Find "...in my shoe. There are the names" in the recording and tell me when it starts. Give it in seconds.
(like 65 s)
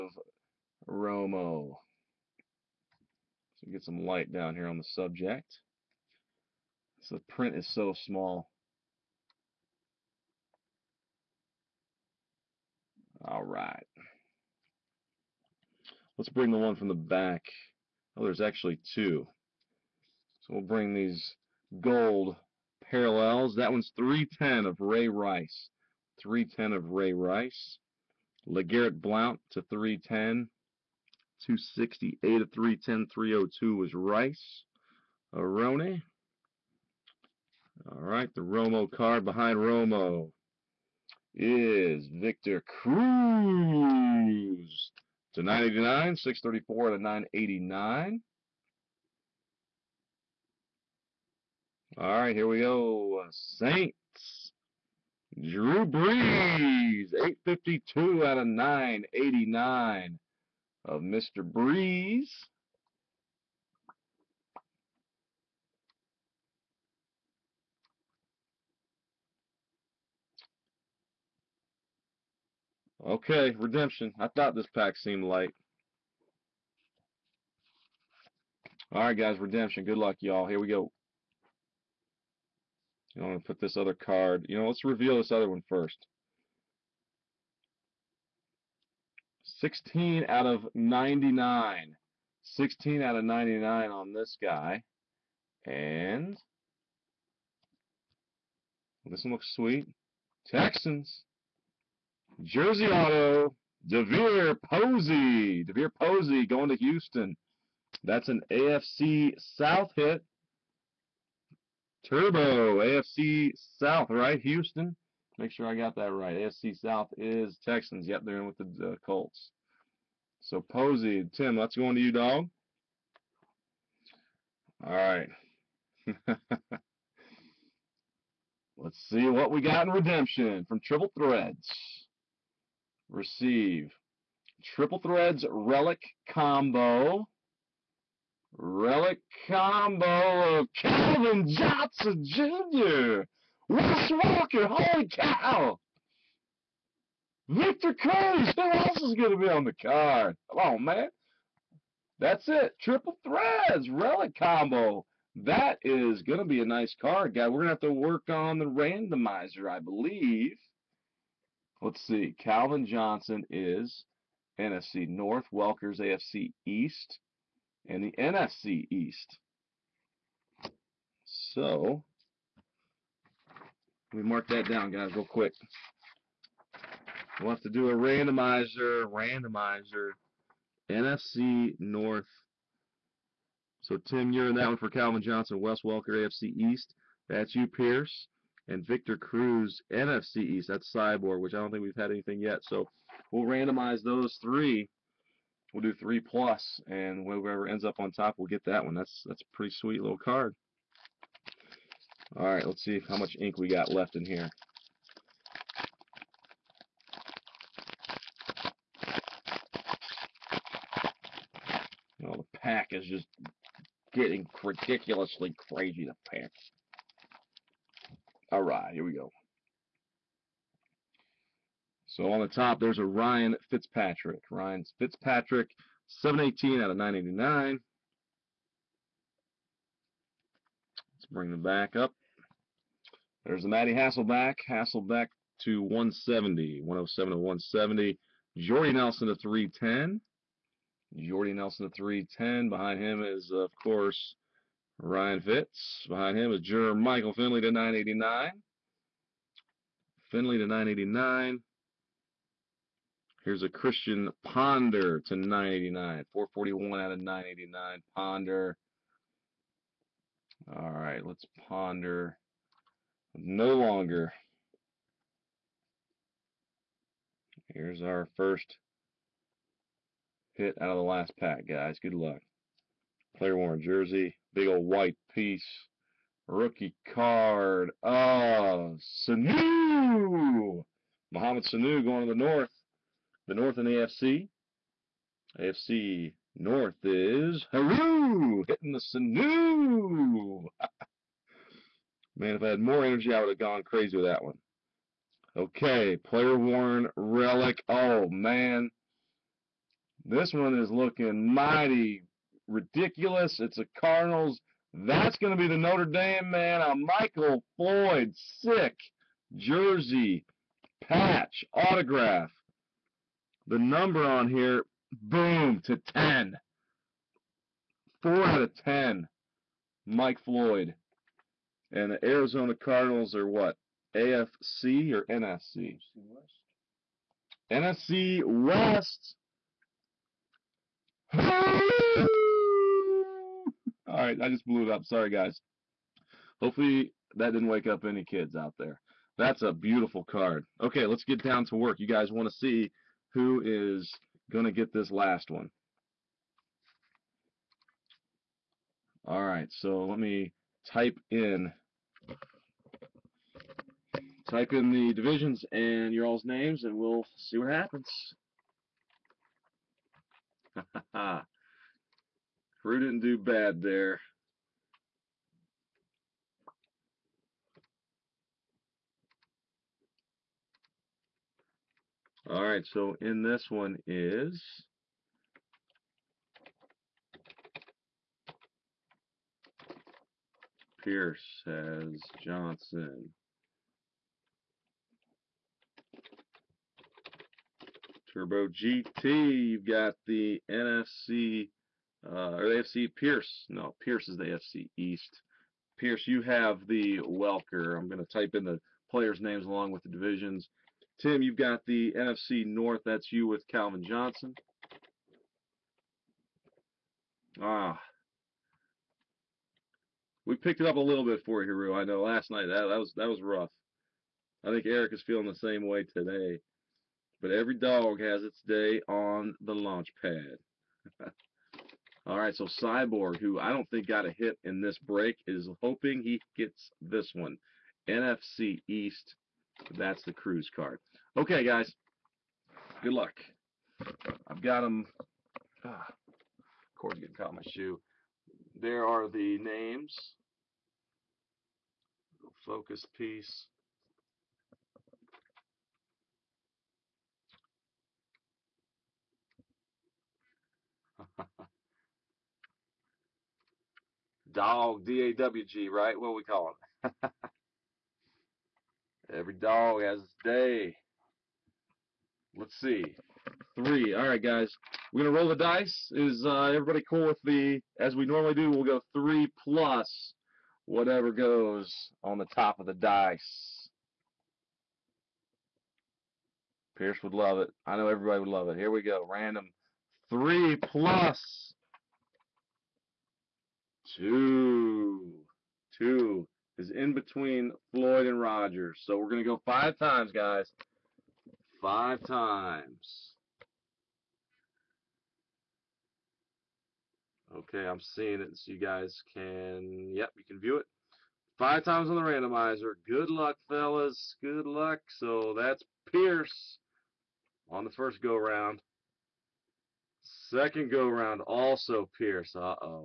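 437 s.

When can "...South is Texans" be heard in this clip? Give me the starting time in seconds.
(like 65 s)
116 s.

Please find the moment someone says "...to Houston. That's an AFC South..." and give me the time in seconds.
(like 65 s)
106 s.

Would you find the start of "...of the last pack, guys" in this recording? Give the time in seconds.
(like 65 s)
270 s.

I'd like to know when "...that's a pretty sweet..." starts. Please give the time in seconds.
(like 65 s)
199 s.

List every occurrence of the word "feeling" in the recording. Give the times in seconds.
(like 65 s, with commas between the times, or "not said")
415 s.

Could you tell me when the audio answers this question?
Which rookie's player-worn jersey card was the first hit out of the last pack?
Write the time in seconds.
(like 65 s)
281 s.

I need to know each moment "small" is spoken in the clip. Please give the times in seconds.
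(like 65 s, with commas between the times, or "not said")
8 s.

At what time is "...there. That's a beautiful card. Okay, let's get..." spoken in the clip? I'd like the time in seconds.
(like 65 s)
338 s.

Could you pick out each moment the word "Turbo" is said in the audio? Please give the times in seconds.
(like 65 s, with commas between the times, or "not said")
112 s, 388 s.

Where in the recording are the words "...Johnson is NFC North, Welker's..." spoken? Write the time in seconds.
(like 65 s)
162 s.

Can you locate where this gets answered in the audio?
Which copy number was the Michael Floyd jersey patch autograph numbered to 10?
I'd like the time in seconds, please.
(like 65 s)
318 s.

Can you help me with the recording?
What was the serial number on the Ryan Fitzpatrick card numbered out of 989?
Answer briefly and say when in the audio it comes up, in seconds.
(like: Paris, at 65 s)
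718, at 226 s.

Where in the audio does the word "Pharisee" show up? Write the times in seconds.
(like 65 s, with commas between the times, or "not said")
not said.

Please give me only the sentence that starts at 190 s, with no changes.
That's Cyborg, which I don't think we've had anything yet.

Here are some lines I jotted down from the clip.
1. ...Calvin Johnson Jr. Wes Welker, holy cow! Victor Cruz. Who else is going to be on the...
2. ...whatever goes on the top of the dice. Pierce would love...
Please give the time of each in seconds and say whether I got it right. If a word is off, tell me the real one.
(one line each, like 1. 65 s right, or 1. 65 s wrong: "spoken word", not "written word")
1. 140 s right
2. 470 s right.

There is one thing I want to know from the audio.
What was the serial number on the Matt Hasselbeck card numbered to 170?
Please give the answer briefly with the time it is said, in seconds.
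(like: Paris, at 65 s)
107, at 236 s.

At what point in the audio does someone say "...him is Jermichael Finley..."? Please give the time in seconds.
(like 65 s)
246 s.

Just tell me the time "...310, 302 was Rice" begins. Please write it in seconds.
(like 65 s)
32 s.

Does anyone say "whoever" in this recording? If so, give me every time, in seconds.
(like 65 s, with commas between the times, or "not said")
197 s.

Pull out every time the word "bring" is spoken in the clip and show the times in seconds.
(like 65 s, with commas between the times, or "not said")
16 s, 20 s, 231 s.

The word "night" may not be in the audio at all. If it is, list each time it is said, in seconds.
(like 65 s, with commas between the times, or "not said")
412 s.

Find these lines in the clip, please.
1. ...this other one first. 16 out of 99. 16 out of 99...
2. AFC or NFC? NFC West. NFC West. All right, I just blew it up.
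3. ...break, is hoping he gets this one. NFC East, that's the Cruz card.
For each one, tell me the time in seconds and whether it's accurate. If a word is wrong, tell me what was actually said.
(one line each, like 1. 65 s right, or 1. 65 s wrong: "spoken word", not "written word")
1. 85 s right
2. 324 s right
3. 424 s right.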